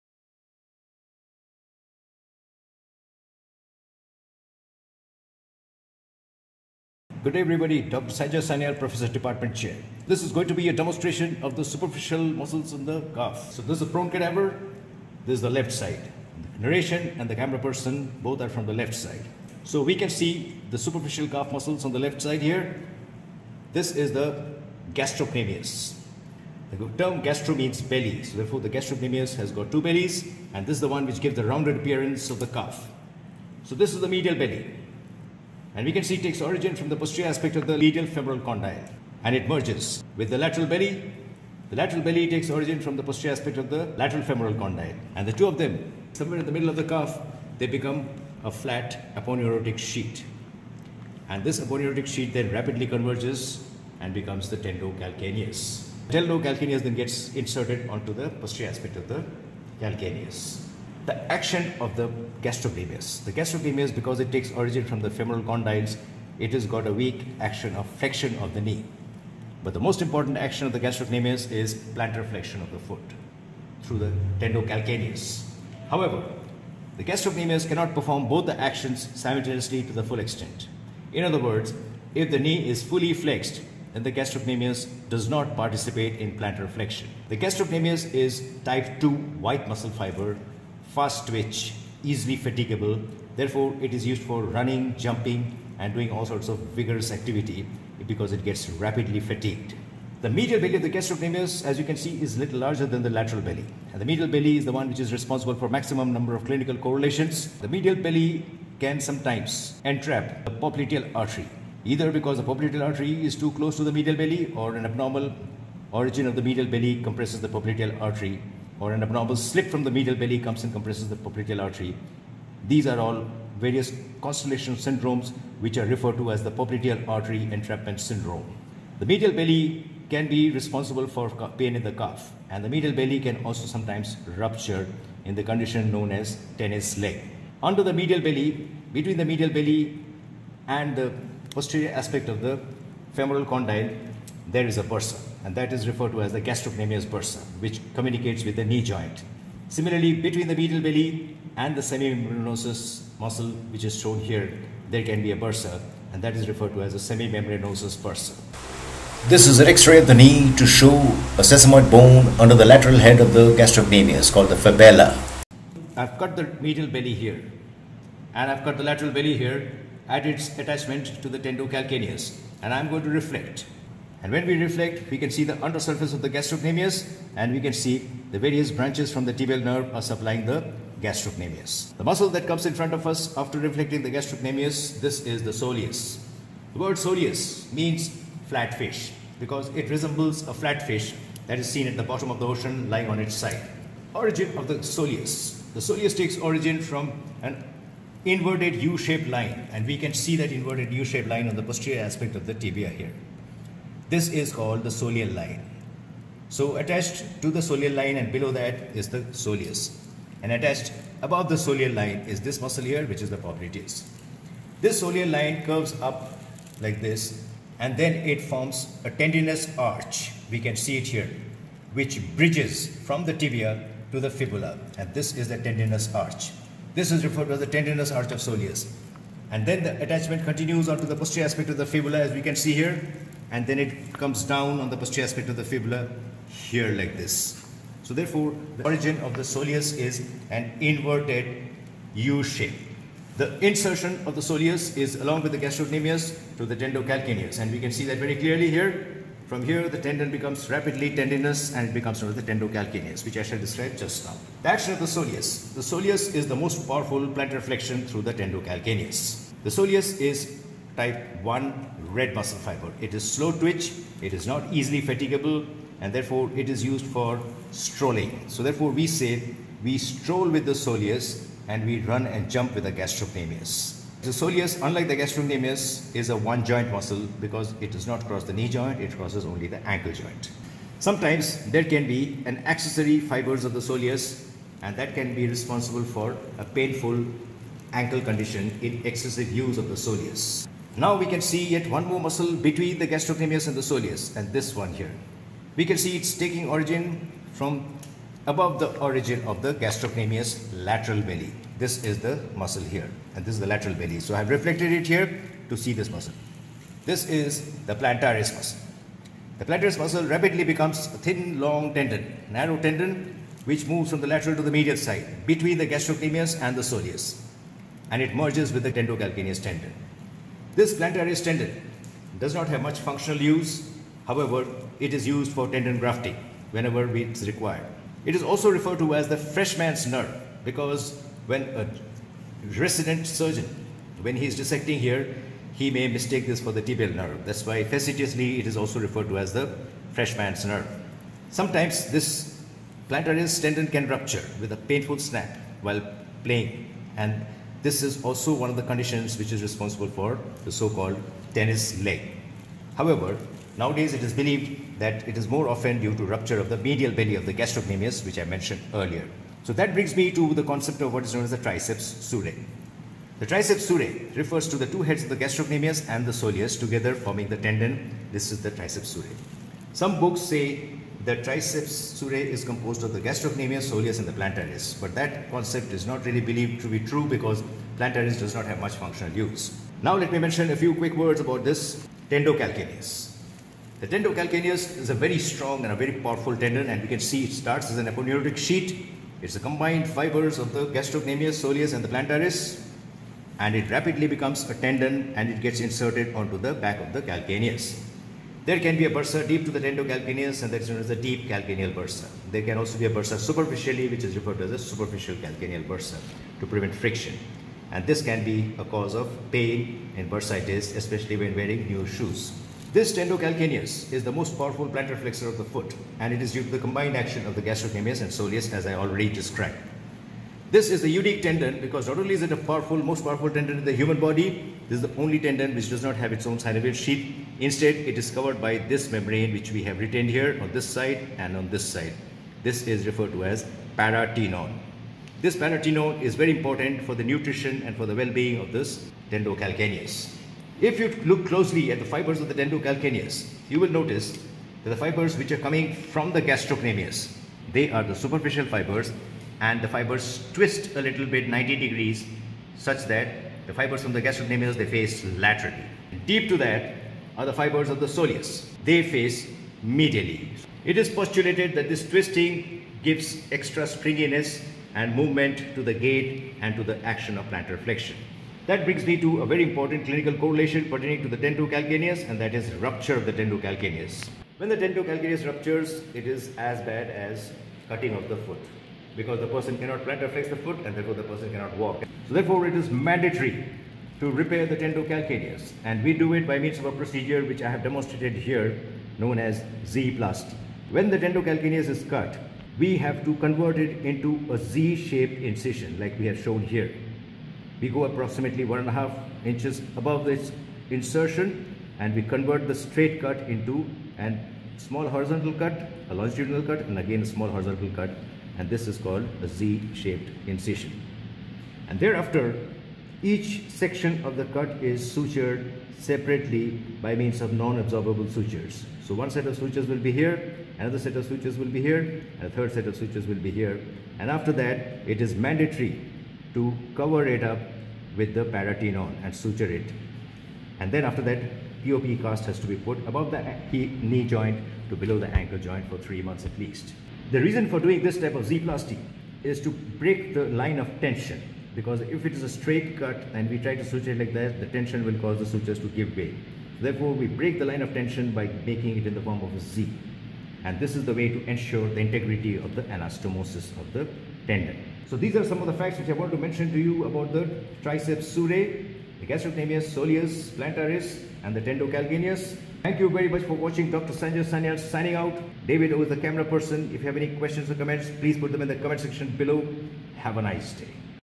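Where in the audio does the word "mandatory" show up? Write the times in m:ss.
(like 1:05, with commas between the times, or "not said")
8:02, 8:45.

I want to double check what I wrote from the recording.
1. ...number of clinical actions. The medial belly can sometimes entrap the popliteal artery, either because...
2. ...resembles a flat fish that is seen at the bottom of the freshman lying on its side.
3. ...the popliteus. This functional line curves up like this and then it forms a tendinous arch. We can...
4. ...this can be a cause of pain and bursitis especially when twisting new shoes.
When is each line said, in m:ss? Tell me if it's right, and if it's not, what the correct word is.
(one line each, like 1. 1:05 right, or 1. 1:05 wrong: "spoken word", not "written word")
1. 1:46 wrong: "correlations", not "actions"
2. 3:09 wrong: "ocean", not "freshman"
3. 3:33 wrong: "soleal", not "functional"
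4. 6:48 wrong: "wearing", not "twisting".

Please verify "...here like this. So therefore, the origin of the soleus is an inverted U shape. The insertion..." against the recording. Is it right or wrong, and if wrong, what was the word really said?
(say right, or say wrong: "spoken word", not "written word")
right.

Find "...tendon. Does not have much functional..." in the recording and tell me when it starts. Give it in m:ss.
5:21.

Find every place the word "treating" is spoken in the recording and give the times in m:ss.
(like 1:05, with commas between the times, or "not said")
not said.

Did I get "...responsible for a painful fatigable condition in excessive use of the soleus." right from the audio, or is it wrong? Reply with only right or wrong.
wrong.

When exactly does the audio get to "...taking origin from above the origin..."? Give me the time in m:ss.
4:56.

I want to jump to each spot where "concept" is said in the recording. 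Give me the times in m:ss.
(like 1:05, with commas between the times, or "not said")
6:00, 6:15.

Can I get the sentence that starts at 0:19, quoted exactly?
So we can see the superficial calf muscles on the left side here.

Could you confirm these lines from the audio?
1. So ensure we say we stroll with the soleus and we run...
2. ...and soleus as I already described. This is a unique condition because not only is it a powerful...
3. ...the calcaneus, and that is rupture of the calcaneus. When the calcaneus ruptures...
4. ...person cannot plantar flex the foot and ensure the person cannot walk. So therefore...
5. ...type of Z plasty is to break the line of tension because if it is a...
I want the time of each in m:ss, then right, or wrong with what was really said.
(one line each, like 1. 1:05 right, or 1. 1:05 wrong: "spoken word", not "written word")
1. 4:28 wrong: "therefore", not "ensure"
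2. 6:58 wrong: "tendon", not "condition"
3. 7:51 right
4. 7:59 wrong: "therefore", not "ensure"
5. 8:58 right.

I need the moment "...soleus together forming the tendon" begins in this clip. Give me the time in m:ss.
6:06.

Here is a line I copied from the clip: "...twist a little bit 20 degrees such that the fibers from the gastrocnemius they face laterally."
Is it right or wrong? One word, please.
wrong.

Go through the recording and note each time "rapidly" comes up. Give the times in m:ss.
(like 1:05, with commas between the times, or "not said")
0:52, 1:38, 4:10, 5:10, 6:33.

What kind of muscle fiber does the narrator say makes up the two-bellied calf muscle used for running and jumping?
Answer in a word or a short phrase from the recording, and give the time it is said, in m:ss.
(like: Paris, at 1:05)
type 2 white, at 1:28.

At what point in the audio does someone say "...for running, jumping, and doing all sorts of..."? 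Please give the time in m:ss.
1:34.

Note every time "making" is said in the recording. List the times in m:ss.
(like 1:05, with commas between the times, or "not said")
9:08.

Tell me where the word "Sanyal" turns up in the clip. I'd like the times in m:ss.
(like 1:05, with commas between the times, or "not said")
0:08, 9:24.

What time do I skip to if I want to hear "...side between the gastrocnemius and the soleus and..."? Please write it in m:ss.
5:14.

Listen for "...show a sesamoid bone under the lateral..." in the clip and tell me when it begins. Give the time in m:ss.
2:40.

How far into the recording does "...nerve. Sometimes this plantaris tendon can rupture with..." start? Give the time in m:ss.
5:40.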